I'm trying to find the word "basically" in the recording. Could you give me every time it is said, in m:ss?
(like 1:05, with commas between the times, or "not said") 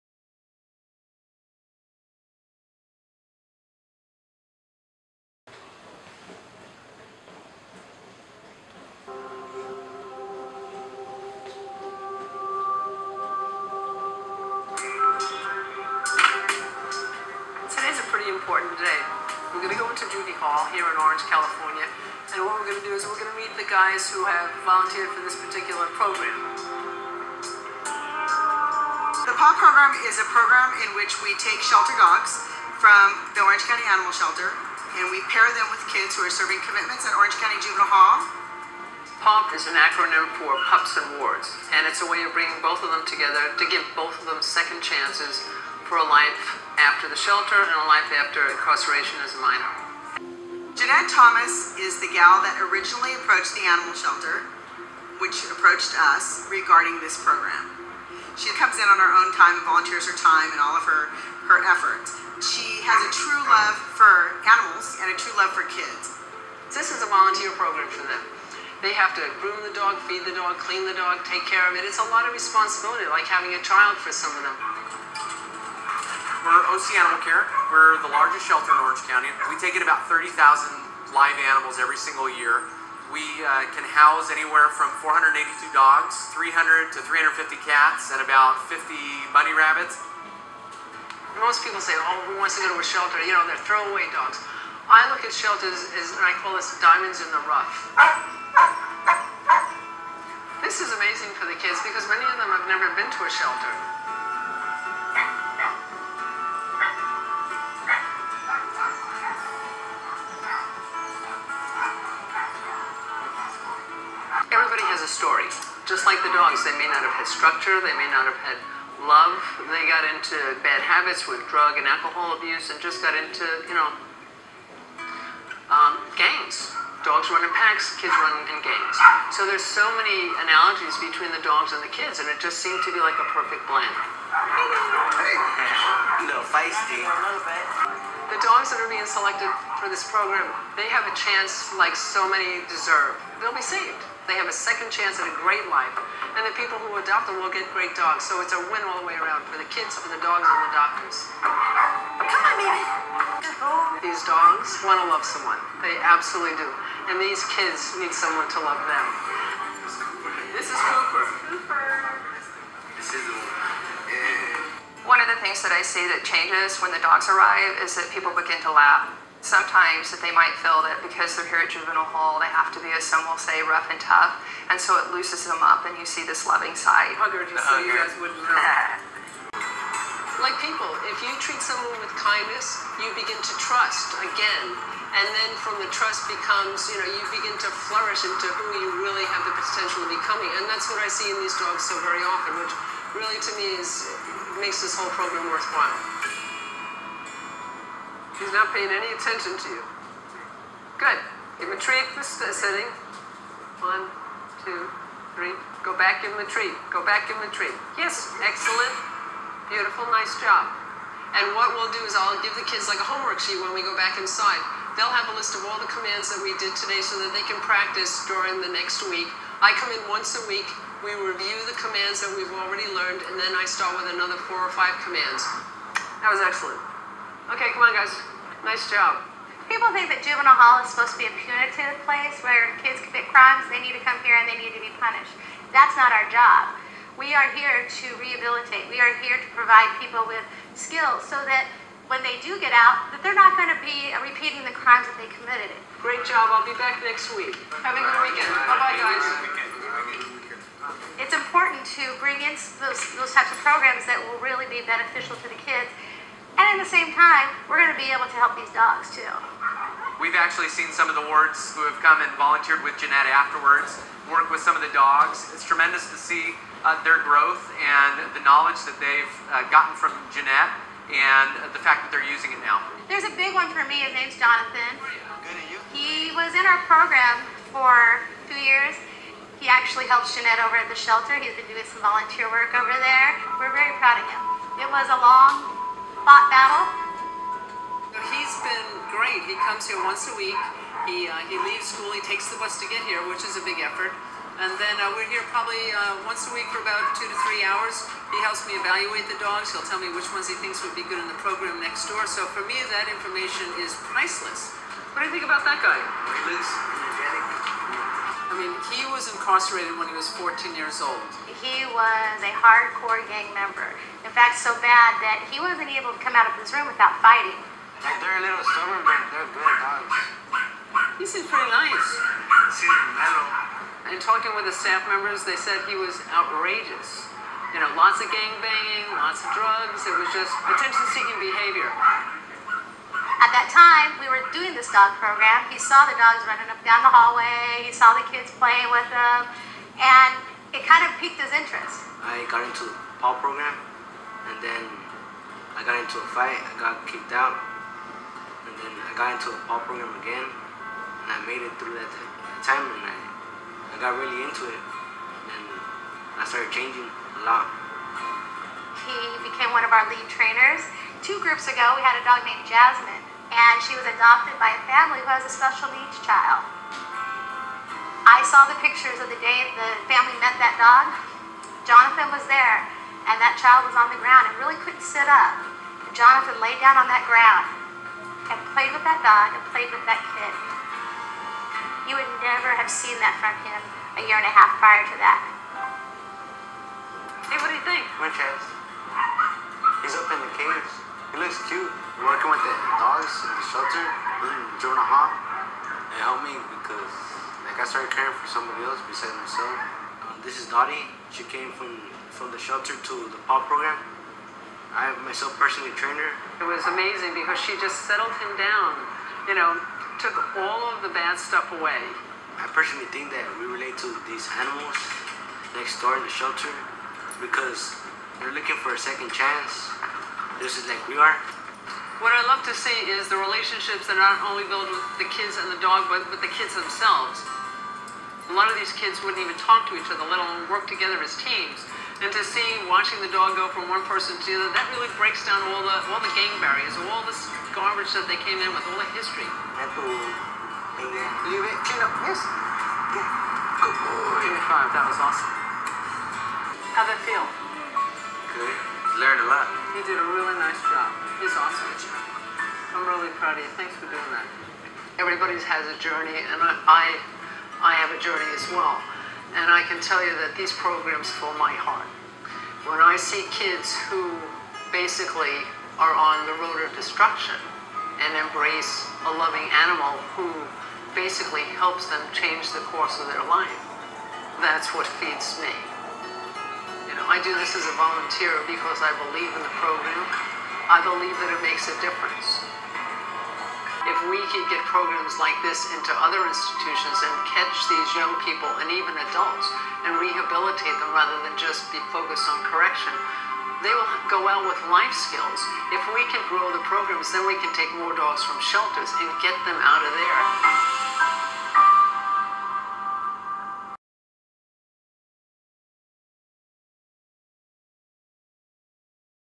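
7:44, 7:51.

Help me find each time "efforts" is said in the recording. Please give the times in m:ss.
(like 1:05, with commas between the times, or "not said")
1:01, 4:53.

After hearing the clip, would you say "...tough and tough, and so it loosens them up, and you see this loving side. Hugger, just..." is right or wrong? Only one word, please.
wrong.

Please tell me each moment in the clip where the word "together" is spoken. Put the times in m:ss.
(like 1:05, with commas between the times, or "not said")
0:43, 7:10.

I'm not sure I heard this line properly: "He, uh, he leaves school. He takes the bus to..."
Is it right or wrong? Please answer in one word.
right.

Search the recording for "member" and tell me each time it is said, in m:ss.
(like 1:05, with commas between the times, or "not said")
5:13, 5:25.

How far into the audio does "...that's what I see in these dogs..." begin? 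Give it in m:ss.
3:10.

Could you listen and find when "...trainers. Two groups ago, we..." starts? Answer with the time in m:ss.
6:00.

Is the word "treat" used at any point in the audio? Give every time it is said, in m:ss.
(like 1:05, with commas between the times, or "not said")
3:01.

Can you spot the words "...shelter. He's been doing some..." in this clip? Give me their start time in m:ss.
4:40.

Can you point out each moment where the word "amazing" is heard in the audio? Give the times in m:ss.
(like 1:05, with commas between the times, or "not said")
1:40, 6:46.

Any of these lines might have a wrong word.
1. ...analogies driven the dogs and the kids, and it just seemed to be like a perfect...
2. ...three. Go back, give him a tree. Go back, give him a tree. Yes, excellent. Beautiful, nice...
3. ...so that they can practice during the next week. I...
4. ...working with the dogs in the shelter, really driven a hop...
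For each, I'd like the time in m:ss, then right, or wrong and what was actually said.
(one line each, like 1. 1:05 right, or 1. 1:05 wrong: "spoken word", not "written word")
1. 2:10 wrong: "between", not "driven"
2. 3:25 right
3. 3:37 right
4. 6:32 right.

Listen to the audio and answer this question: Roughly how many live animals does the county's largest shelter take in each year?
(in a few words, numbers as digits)
30,000.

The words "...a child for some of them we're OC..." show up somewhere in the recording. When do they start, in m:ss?
1:13.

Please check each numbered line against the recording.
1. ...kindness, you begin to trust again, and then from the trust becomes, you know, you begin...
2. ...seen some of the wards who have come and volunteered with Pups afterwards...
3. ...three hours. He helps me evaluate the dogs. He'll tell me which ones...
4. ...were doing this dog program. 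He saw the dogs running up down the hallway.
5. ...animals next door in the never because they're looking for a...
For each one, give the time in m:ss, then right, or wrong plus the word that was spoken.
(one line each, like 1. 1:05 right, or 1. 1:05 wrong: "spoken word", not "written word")
1. 3:02 right
2. 4:20 wrong: "Janette", not "Pups"
3. 4:57 right
4. 5:34 right
5. 6:54 wrong: "shelter", not "never".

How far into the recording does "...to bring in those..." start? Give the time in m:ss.
4:11.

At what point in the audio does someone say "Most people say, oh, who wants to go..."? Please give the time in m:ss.
1:31.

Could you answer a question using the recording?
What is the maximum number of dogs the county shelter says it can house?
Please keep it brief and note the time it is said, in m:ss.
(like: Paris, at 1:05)
482, at 1:25.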